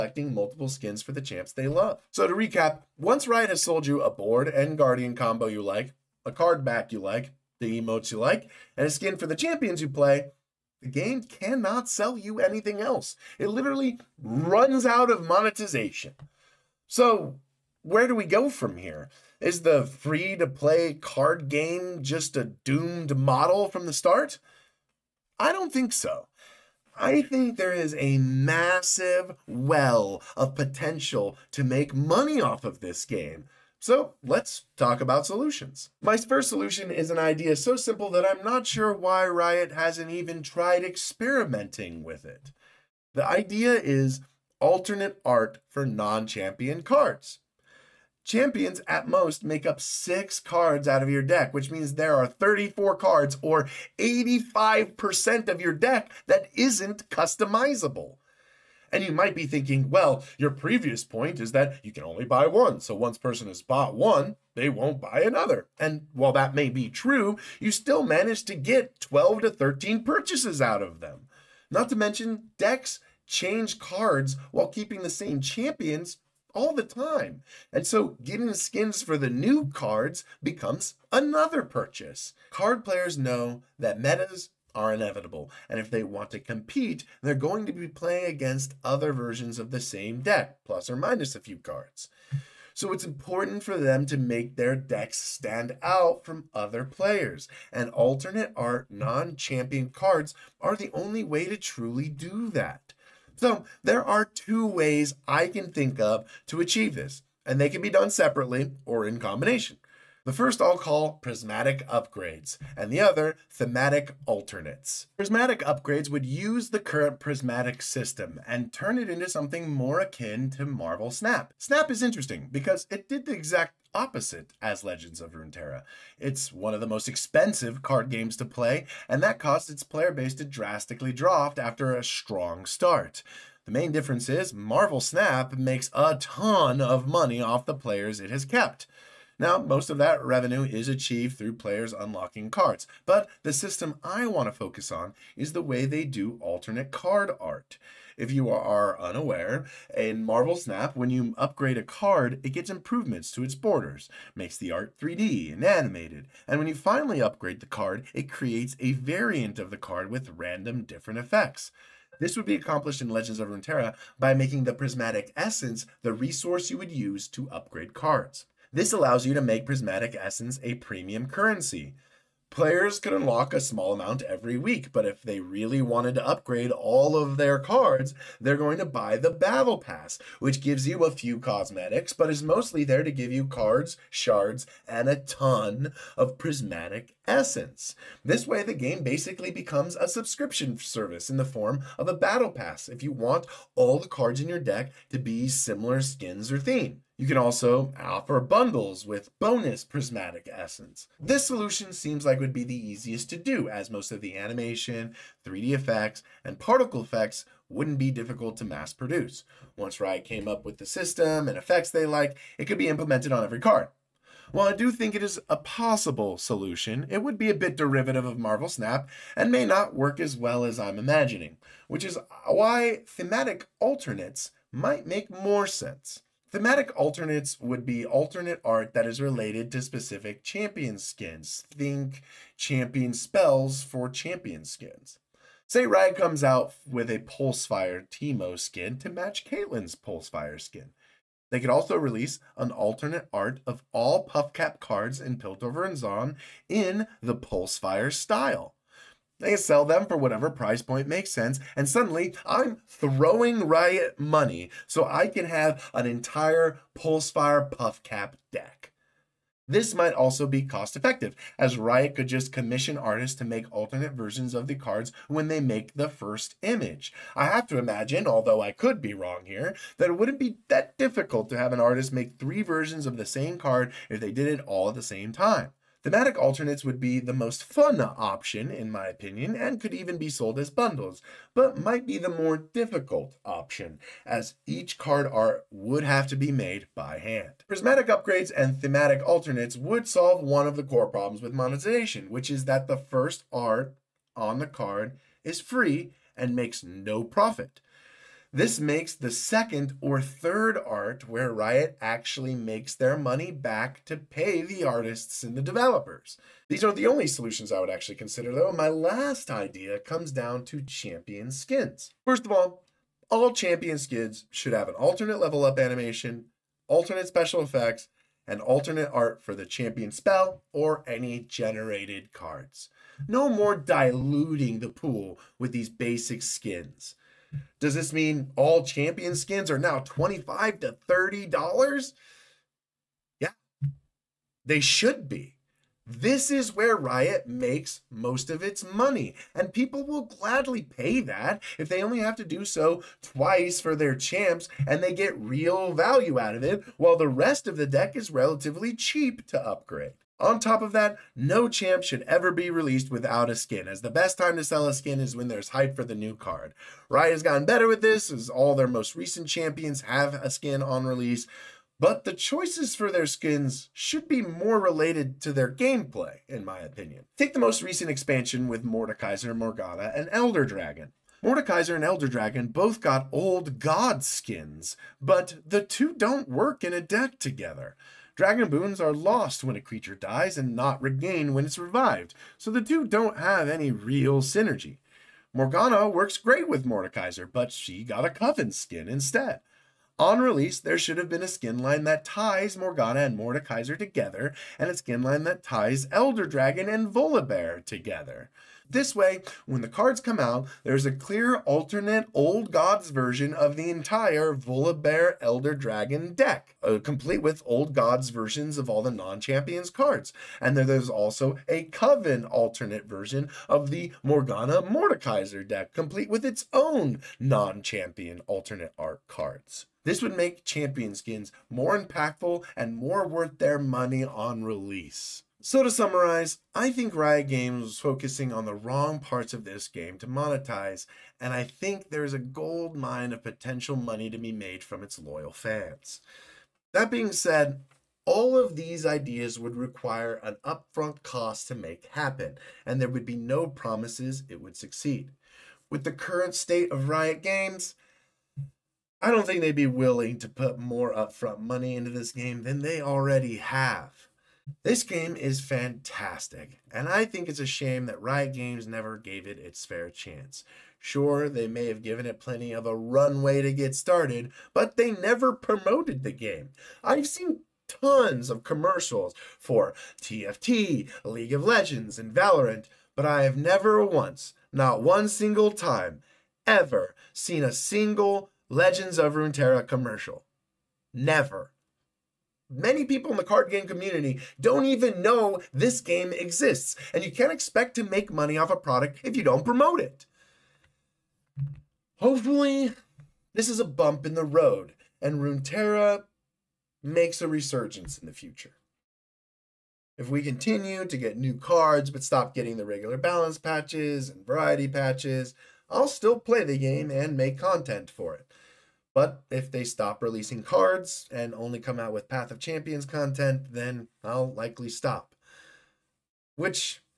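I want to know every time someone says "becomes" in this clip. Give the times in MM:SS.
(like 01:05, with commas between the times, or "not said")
01:20, 03:09.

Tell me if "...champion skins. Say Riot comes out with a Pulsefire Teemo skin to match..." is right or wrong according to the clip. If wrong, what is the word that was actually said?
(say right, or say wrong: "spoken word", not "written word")
right.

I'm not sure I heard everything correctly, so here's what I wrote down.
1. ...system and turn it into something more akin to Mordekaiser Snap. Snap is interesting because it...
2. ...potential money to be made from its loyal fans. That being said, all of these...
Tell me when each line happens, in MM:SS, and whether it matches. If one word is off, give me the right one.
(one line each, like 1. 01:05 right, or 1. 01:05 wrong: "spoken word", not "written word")
1. 01:57 wrong: "Marvel", not "Mordekaiser"
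2. 07:13 right.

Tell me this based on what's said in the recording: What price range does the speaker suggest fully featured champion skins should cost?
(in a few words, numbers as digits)
$25 to $30.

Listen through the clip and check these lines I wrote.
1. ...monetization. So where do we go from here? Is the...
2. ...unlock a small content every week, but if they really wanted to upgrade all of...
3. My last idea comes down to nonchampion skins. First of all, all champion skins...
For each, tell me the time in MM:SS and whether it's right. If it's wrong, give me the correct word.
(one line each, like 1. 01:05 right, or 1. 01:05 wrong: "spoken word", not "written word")
1. 00:15 right
2. 02:53 wrong: "amount", not "content"
3. 05:08 wrong: "champion", not "nonchampion".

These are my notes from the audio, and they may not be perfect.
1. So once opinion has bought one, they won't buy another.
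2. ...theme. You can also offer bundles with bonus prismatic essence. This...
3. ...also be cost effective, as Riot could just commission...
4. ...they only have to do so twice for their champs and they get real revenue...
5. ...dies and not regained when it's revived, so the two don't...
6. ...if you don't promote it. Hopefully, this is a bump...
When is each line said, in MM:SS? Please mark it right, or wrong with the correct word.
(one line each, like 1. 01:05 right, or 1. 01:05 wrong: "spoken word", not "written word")
1. 01:02 wrong: "person", not "opinion"
2. 03:16 right
3. 04:20 right
4. 05:41 wrong: "value", not "revenue"
5. 06:20 right
6. 08:09 right.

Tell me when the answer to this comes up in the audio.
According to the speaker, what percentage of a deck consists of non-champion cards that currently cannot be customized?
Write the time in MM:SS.
00:53.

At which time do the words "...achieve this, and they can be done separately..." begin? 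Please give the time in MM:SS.
01:46.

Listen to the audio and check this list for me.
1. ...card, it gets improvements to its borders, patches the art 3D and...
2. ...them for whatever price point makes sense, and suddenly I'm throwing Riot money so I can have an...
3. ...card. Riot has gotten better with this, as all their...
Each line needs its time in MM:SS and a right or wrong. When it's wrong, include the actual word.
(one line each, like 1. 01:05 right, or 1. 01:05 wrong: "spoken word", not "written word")
1. 02:31 wrong: "makes", not "patches"
2. 04:09 right
3. 05:56 right.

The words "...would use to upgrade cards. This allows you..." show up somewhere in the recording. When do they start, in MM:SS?
02:46.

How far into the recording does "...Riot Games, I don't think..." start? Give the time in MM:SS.
07:27.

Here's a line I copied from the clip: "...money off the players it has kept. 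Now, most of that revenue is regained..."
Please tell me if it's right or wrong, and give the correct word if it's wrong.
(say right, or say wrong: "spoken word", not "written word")
wrong: "achieved", not "regained".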